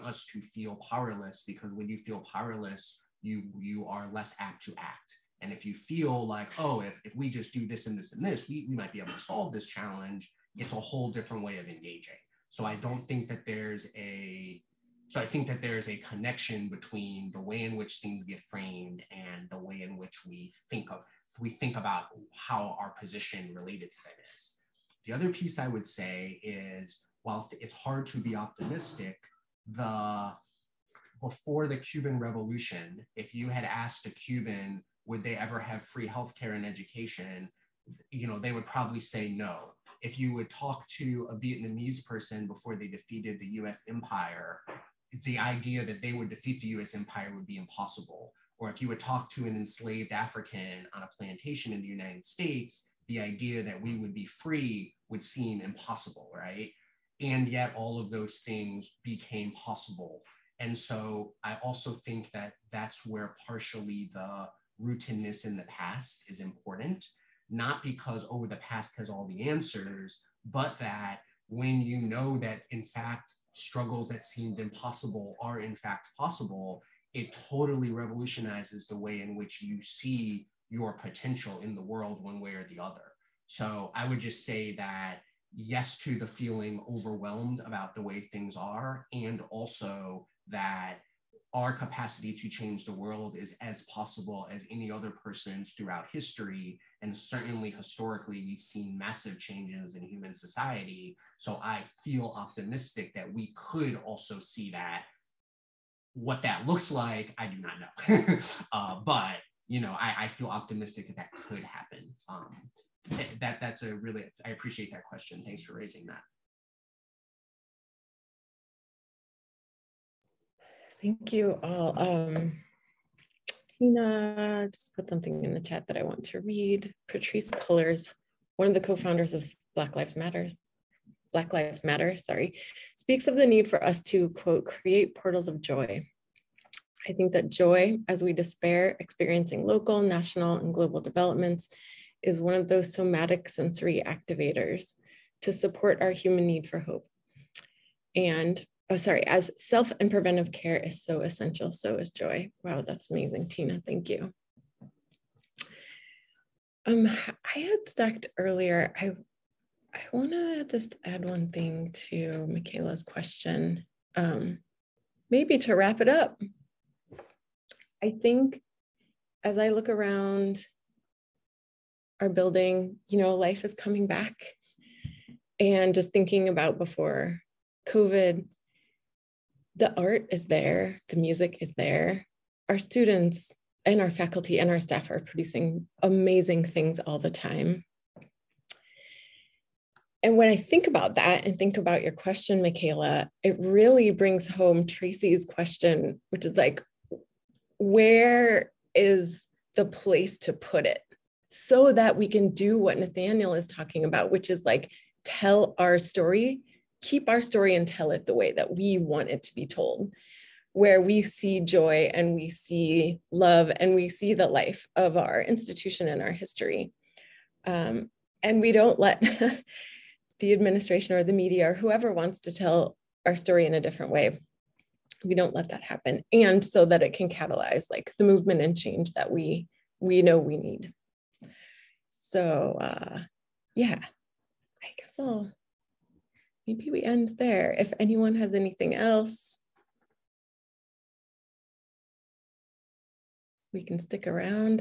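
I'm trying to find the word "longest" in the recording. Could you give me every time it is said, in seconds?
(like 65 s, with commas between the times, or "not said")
not said.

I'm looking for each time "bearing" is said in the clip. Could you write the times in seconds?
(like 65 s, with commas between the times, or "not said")
not said.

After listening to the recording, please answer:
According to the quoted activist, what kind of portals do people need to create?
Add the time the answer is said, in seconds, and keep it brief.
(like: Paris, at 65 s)
Portals of joy, at 135 s.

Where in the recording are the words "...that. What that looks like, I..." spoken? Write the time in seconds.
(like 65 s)
104 s.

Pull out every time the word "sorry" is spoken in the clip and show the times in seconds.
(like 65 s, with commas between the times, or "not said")
132 s, 148 s.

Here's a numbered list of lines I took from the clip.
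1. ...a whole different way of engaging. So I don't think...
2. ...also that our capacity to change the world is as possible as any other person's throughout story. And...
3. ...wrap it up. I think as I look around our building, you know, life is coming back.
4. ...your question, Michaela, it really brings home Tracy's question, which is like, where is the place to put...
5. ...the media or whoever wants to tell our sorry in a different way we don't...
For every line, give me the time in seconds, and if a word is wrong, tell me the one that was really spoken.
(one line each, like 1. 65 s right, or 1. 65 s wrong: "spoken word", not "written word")
1. 10 s right
2. 89 s wrong: "history", not "story"
3. 165 s right
4. 192 s right
5. 221 s wrong: "story", not "sorry".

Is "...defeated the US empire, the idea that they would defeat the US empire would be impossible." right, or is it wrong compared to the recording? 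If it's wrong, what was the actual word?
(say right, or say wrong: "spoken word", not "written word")
right.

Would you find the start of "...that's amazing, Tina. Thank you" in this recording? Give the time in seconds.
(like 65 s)
152 s.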